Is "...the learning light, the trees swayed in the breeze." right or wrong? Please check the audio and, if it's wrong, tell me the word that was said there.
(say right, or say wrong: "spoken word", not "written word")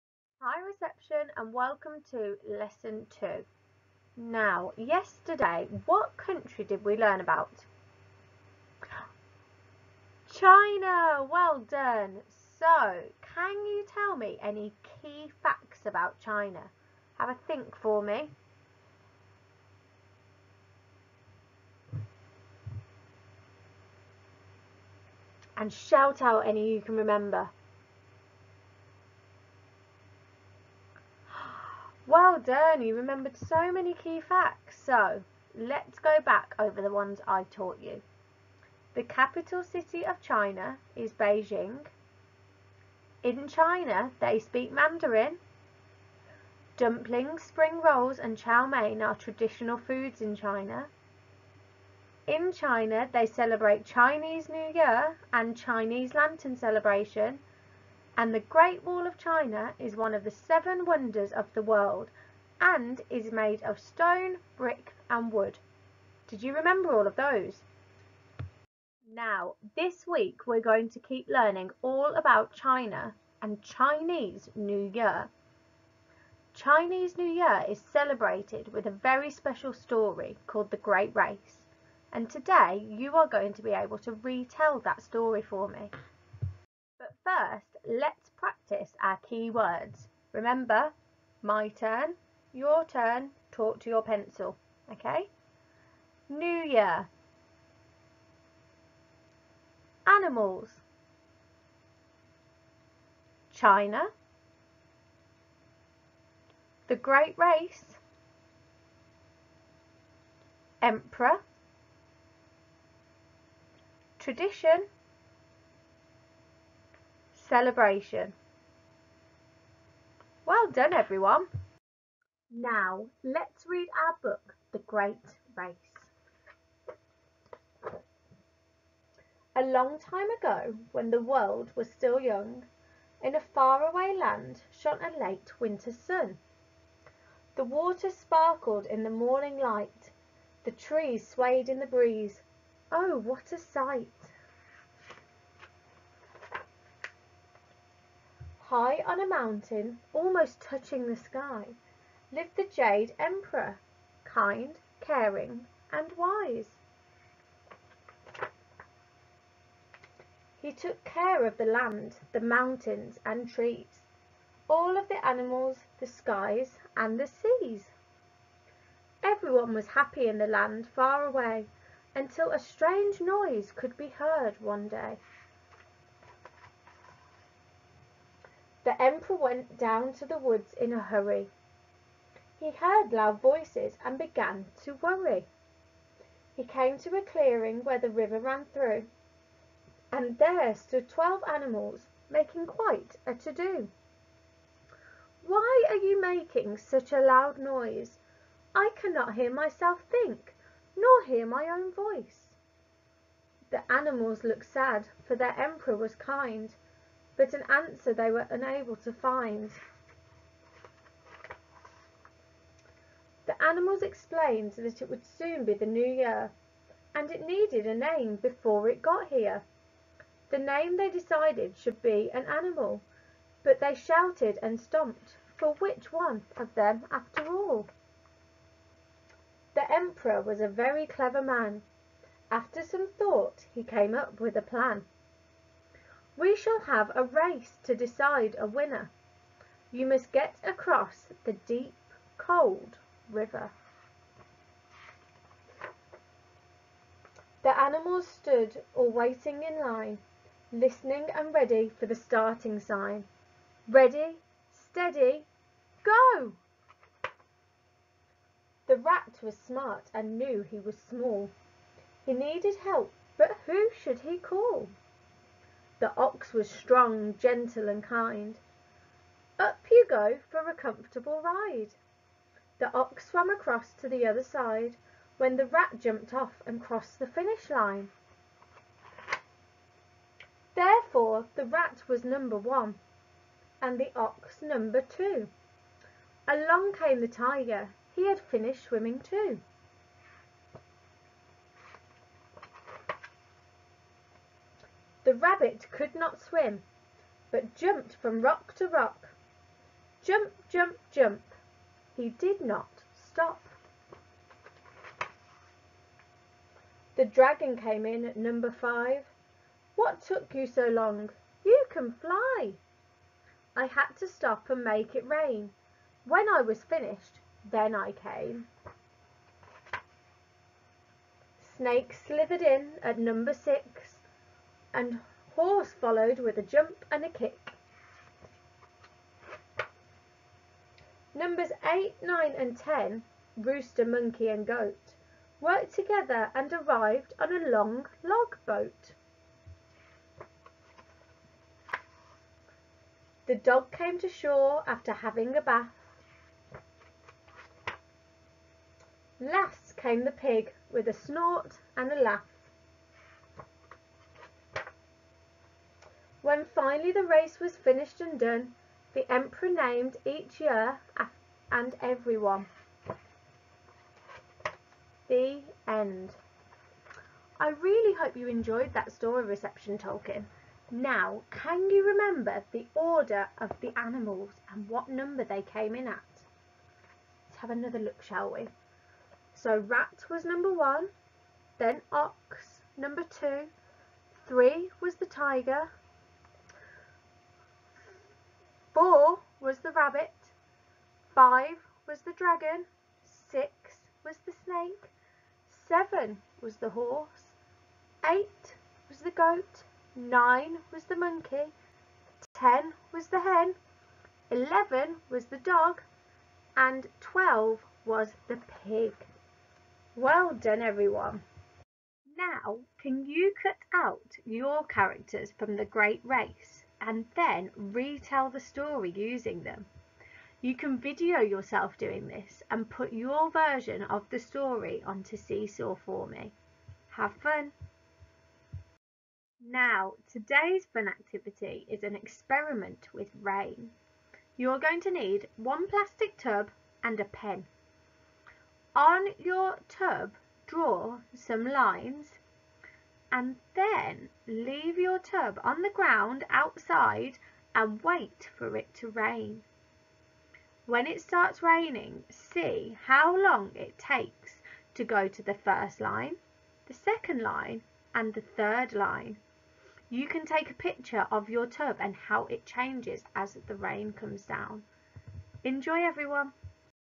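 wrong: "morning", not "learning".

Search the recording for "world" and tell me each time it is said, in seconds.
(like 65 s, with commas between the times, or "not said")
61 s, 131 s.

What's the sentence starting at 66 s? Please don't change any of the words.
Did you remember all of those?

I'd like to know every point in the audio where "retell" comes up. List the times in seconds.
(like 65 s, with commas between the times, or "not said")
84 s, 417 s.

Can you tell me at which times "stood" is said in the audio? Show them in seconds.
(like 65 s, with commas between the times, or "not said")
190 s, 248 s.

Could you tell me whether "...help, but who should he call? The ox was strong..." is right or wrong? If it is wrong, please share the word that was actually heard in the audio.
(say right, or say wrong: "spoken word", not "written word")
right.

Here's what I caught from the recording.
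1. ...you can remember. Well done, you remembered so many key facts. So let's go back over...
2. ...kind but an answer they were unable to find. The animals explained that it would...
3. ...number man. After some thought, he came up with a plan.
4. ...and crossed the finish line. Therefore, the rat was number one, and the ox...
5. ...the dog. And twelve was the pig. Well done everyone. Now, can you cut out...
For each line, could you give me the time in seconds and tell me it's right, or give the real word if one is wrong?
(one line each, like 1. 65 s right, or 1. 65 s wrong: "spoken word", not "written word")
1. 26 s right
2. 206 s right
3. 231 s wrong: "clever", not "number"
4. 276 s right
5. 405 s right.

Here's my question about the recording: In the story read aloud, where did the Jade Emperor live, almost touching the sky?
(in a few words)
On a mountain.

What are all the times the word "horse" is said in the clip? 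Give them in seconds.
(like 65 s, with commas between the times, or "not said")
325 s, 396 s.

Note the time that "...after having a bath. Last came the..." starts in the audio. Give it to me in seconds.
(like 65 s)
344 s.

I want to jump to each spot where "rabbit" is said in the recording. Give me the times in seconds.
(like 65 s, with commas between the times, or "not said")
295 s, 389 s.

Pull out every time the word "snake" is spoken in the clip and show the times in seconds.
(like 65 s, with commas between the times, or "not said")
321 s, 394 s.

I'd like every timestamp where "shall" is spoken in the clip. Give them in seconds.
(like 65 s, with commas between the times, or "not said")
236 s, 378 s.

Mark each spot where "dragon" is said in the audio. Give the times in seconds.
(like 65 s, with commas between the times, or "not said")
307 s, 392 s.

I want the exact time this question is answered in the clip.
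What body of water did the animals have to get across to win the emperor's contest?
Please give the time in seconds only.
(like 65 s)
241 s.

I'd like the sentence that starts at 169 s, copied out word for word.
Everyone was happy in the land far away until a strange noise could be heard one day.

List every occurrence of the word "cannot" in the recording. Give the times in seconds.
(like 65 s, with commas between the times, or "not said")
198 s.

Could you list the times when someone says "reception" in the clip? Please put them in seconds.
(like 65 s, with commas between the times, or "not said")
0 s, 369 s.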